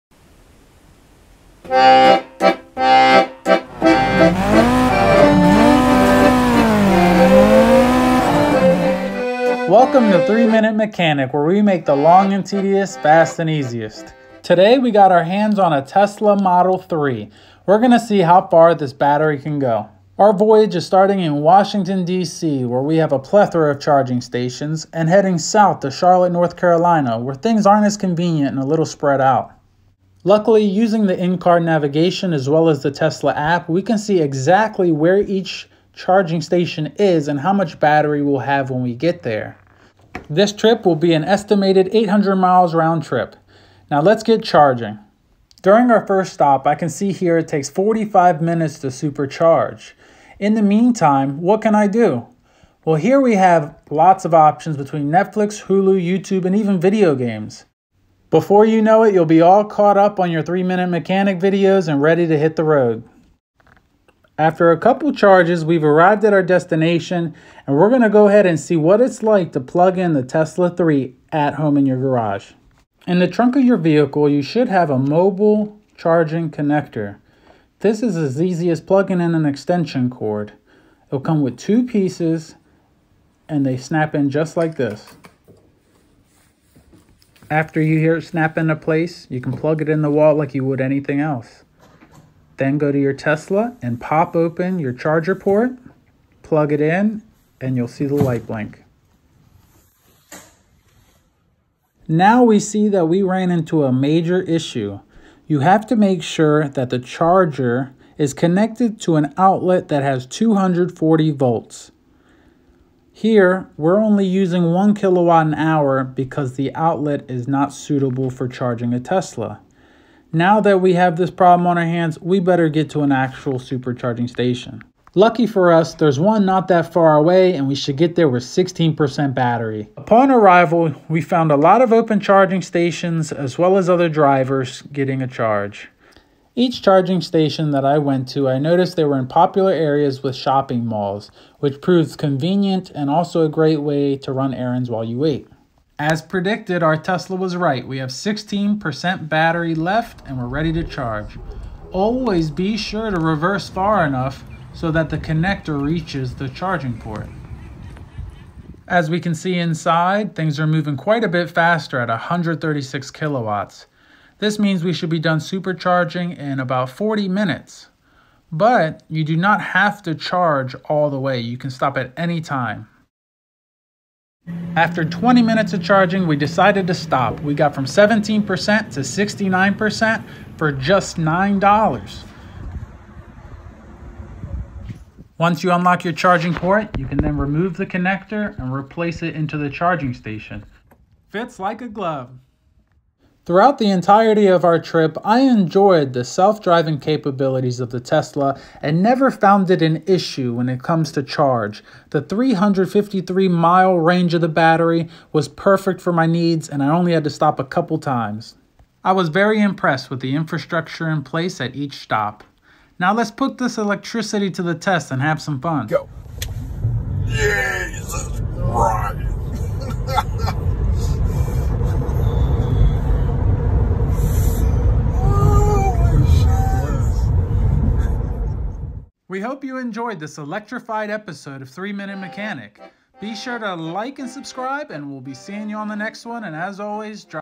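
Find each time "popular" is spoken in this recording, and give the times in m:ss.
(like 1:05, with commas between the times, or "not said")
2:19.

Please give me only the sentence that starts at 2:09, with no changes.
Upon arrival, we found a lot of open charging stations as well as other drivers getting a charge.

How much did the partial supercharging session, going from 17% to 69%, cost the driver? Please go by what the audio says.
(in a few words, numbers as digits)
$9.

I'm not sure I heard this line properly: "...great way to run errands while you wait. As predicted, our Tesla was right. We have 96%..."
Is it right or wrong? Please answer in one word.
wrong.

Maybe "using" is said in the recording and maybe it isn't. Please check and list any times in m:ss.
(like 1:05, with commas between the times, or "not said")
0:30, 1:54.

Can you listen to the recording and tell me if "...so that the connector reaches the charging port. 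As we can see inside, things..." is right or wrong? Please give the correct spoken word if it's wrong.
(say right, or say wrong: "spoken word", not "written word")
right.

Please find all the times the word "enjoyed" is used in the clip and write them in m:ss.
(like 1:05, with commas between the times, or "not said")
3:15, 3:49.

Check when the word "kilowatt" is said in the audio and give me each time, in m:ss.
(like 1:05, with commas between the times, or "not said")
1:54, 2:43.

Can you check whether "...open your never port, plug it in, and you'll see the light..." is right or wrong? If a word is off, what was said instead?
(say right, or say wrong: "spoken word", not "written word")
wrong: "charger", not "never".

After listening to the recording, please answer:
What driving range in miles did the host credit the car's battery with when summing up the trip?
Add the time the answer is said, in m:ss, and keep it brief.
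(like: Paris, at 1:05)
353 miles, at 3:22.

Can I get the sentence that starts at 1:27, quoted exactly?
After you hear it snap into place, you can plug it in the wall like you would anything else.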